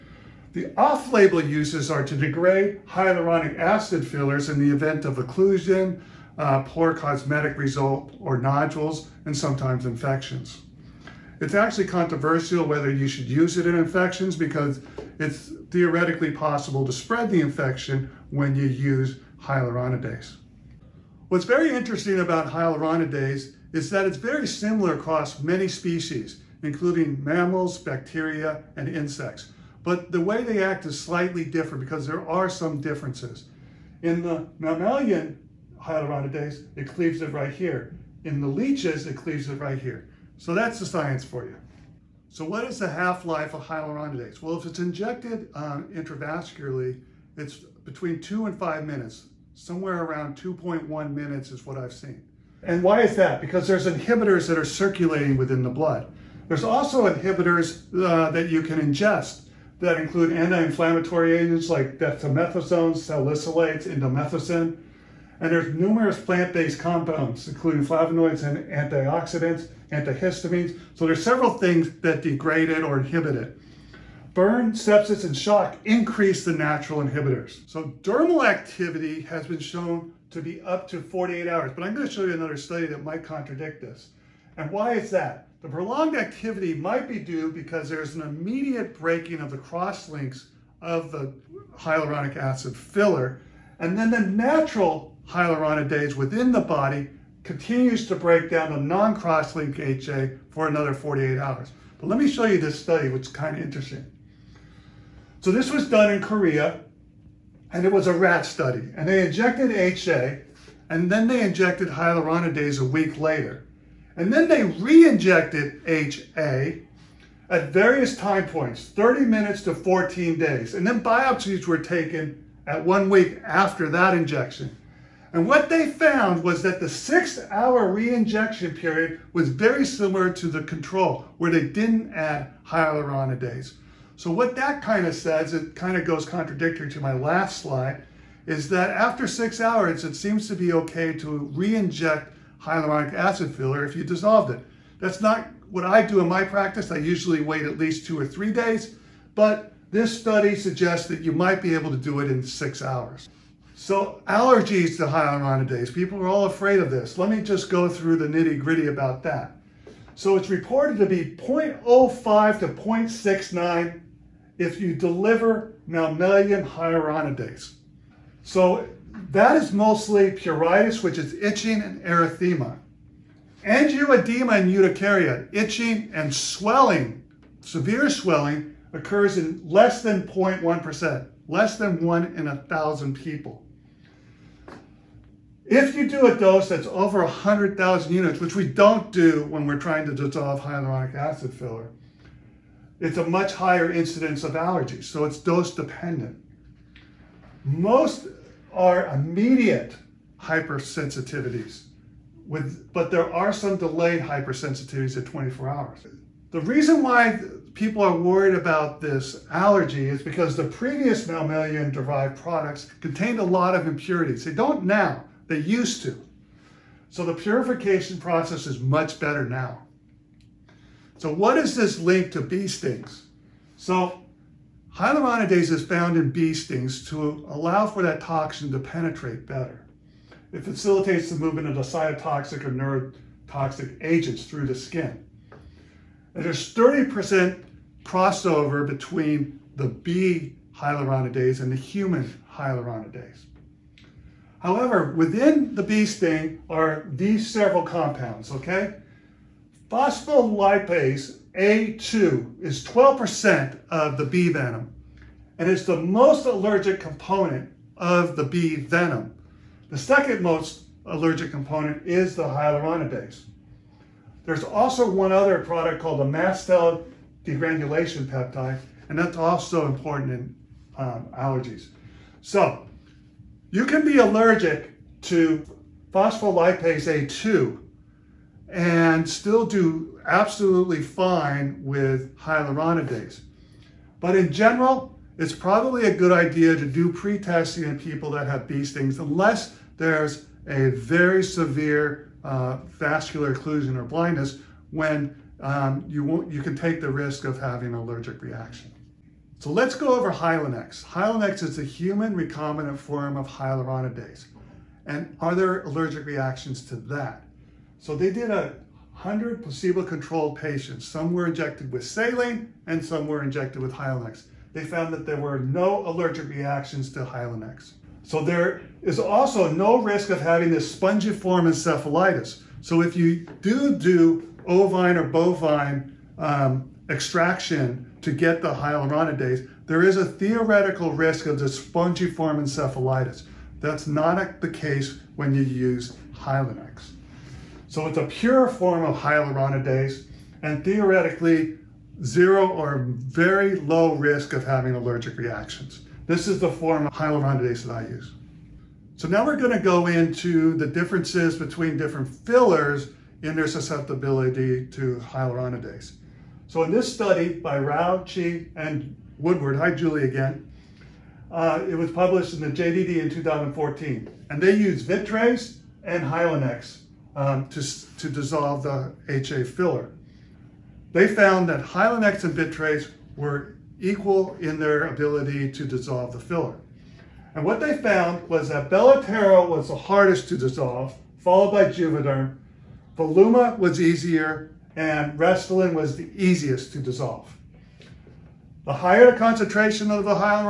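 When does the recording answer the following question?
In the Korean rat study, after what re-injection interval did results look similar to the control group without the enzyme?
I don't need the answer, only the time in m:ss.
2:06.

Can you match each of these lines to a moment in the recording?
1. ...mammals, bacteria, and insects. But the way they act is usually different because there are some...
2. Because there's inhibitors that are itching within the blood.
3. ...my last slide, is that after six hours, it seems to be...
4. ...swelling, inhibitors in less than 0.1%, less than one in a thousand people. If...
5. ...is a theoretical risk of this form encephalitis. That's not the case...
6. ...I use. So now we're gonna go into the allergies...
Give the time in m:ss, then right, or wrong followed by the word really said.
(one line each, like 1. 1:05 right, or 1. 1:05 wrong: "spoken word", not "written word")
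1. 0:27 wrong: "slightly", not "usually"
2. 0:53 wrong: "circulating", not "itching"
3. 2:16 right
4. 2:58 wrong: "occurs", not "inhibitors"
5. 5:30 right
6. 5:47 wrong: "differences", not "allergies".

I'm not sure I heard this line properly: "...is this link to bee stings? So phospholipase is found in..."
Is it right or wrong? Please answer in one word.
wrong.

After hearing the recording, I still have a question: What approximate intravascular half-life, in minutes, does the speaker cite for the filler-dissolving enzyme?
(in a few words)
2.1 minutes.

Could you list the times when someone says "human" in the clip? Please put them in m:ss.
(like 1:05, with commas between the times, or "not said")
4:01, 5:01.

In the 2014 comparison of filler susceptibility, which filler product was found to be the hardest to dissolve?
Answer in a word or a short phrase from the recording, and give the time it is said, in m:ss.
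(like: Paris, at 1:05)
Belotero, at 6:18.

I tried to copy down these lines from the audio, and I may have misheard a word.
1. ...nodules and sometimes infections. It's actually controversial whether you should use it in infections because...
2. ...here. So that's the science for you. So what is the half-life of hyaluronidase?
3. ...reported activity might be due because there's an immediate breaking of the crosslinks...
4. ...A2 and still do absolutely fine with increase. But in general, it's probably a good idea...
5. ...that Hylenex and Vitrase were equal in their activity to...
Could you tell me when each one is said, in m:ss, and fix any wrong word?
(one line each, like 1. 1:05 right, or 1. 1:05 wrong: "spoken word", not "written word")
1. 0:08 right
2. 0:39 right
3. 1:25 wrong: "prolonged", not "reported"
4. 4:37 wrong: "hyaluronidase", not "increase"
5. 6:11 wrong: "ability", not "activity".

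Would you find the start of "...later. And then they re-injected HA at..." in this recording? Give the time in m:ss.
1:53.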